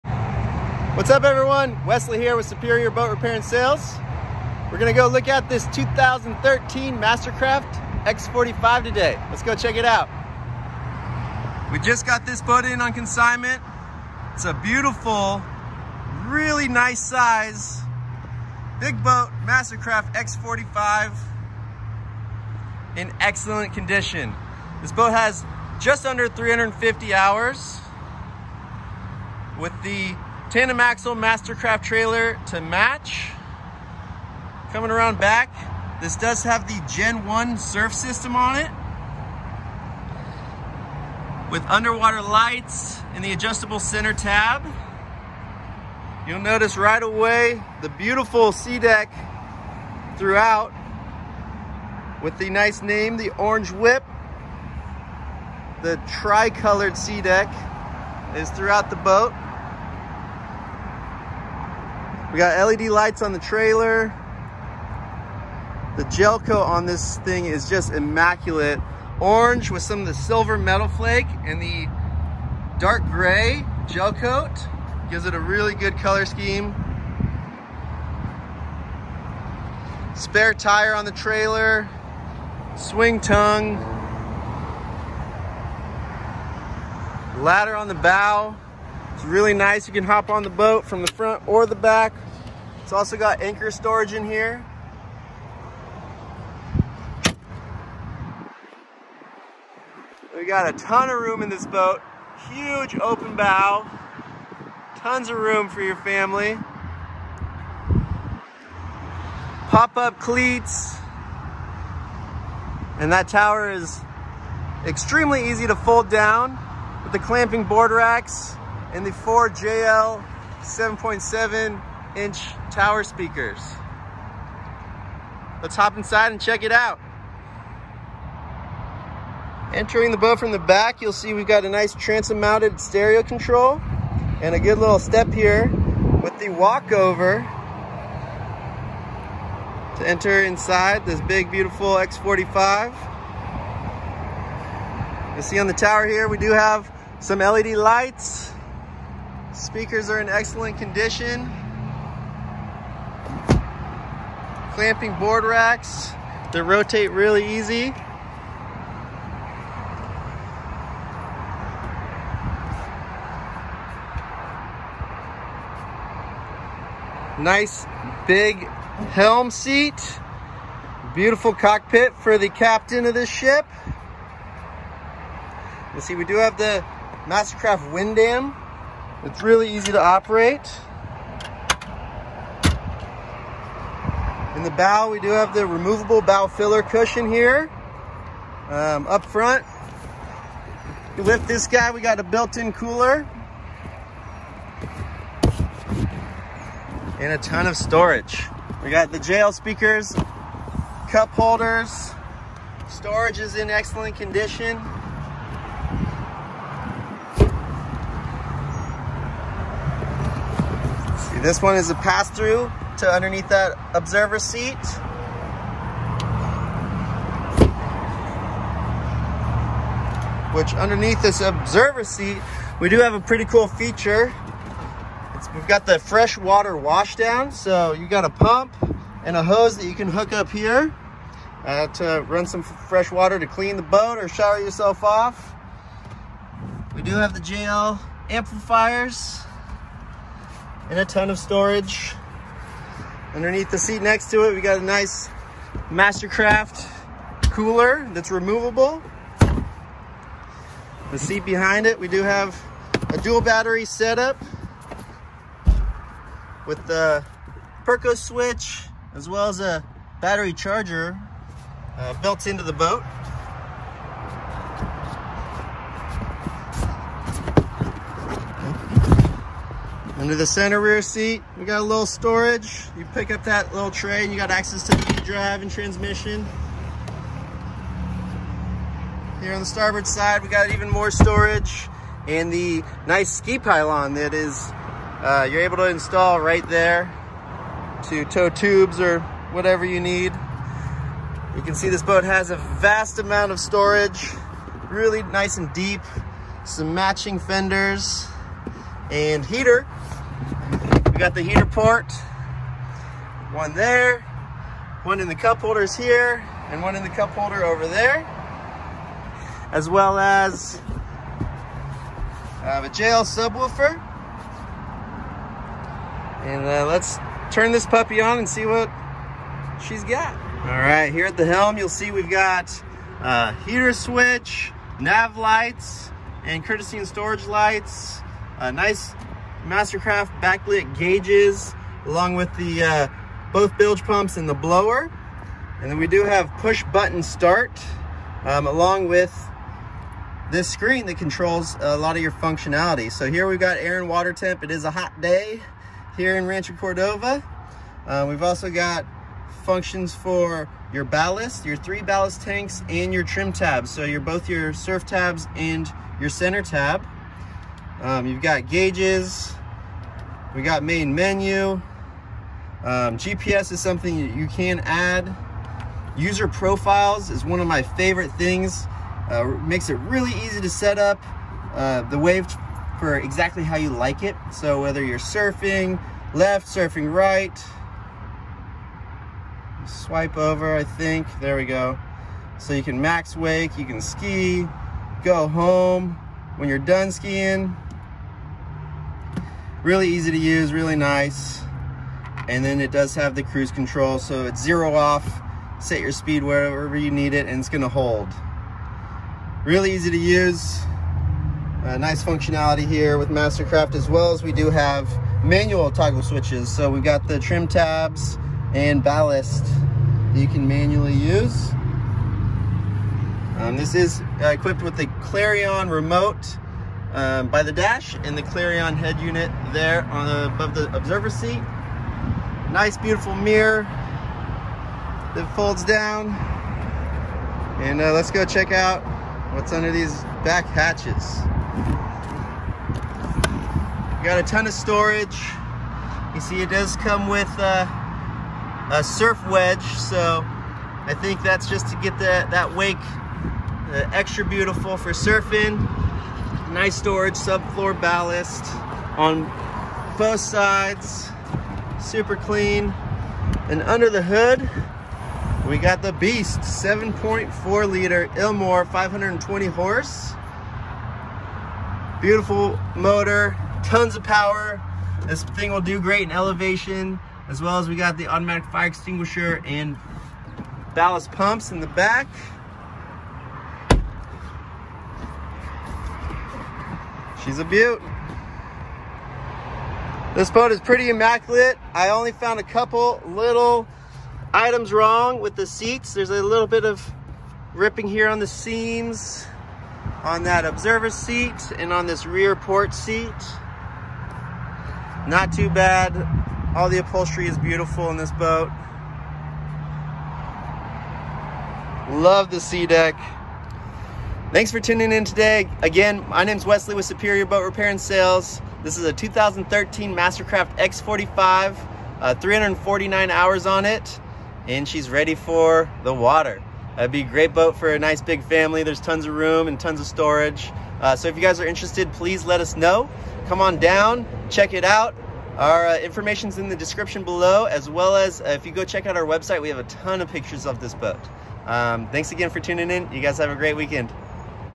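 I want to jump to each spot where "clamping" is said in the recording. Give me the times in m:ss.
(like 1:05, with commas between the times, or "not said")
1:57, 2:34.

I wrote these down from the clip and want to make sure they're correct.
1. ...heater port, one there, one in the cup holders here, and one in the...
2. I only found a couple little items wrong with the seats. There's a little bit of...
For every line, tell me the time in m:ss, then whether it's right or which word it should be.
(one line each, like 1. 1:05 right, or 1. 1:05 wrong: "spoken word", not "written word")
1. 5:01 right
2. 8:01 right.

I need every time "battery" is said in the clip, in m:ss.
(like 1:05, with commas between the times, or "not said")
4:13, 4:20.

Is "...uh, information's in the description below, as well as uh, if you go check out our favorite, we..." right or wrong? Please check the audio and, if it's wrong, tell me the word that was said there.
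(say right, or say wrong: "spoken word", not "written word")
wrong: "website", not "favorite".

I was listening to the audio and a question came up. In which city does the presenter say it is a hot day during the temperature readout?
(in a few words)
Rancho Cordova.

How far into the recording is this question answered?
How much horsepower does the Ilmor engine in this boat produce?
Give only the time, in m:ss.
7:38.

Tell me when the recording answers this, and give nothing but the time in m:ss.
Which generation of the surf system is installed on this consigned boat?
0:36.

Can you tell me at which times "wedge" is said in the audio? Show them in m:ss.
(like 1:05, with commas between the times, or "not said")
7:19.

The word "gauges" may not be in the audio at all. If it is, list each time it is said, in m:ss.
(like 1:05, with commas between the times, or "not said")
5:30, 5:58.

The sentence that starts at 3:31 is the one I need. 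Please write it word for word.
See, this one is a pass-through to underneath that observer seat.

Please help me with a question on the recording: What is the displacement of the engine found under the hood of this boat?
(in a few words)
7.4 liter.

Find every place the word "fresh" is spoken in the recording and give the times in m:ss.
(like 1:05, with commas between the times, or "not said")
3:45, 3:52.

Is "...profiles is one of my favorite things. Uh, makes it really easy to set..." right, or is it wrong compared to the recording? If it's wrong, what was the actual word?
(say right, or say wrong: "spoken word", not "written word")
right.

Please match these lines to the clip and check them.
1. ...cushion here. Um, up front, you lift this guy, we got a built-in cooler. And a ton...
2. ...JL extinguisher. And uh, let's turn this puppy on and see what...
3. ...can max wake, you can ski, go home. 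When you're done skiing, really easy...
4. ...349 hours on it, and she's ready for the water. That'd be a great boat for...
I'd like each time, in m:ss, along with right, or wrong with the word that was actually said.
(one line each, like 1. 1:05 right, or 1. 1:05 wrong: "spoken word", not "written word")
1. 3:06 right
2. 5:12 wrong: "subwoofer", not "extinguisher"
3. 6:22 right
4. 8:32 right.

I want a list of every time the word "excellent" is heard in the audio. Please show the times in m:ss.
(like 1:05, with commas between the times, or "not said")
0:23, 2:30, 3:23.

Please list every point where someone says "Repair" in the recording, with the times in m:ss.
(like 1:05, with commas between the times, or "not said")
0:03, 8:27.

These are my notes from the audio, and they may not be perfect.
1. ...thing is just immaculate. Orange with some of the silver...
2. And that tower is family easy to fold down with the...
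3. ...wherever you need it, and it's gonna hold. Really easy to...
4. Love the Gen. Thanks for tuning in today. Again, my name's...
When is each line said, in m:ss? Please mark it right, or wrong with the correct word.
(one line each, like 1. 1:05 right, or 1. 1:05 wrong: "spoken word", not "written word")
1. 1:07 right
2. 1:52 wrong: "extremely", not "family"
3. 6:36 right
4. 8:22 wrong: "SeaDek", not "Gen".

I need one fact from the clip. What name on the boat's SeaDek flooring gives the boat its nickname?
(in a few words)
Orange Whip.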